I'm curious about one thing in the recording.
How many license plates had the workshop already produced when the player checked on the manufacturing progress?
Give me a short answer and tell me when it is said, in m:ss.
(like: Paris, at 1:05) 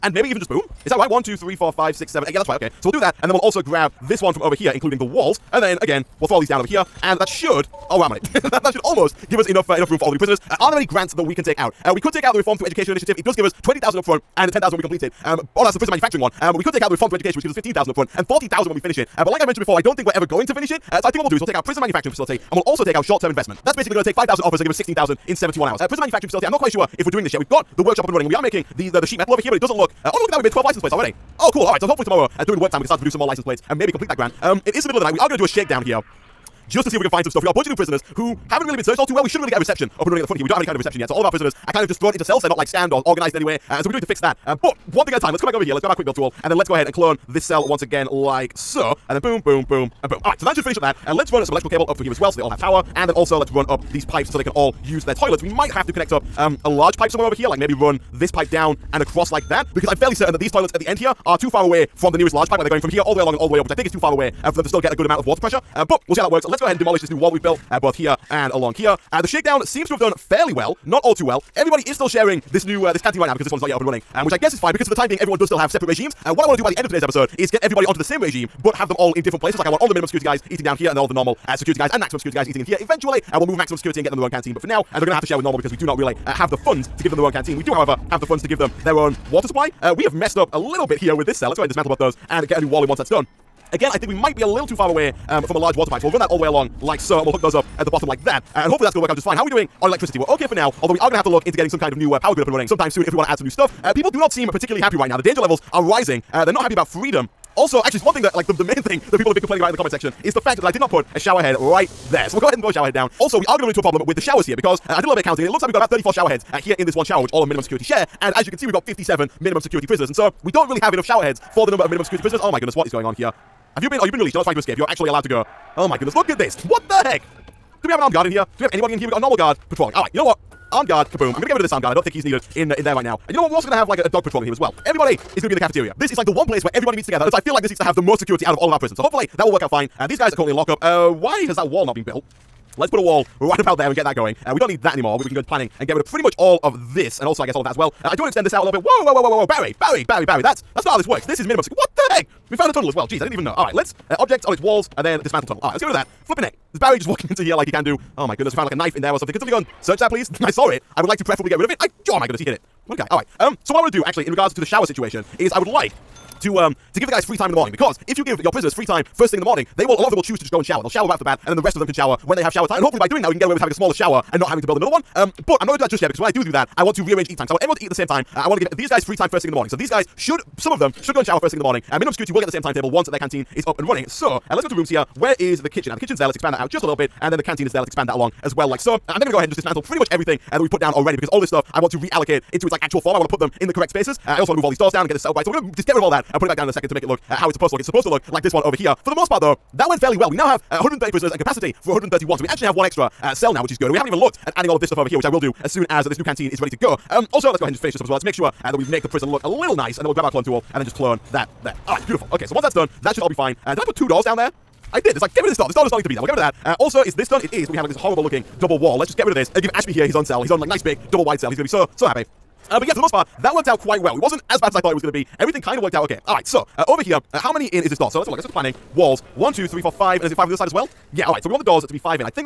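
12, at 0:30.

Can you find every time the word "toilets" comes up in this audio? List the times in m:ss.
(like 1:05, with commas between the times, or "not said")
0:55, 1:00.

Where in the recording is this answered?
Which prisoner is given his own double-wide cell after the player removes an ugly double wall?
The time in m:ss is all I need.
3:39.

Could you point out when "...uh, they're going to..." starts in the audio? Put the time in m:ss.
1:24.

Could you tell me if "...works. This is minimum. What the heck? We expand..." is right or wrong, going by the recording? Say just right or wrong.
wrong.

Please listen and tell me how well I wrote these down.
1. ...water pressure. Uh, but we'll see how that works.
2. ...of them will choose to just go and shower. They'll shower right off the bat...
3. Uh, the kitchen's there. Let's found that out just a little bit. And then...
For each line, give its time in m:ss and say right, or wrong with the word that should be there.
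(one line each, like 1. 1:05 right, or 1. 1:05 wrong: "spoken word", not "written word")
1. 1:05 right
2. 2:50 right
3. 3:05 wrong: "expand", not "found".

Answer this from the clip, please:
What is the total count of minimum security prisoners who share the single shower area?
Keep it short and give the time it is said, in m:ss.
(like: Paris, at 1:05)
57, at 1:58.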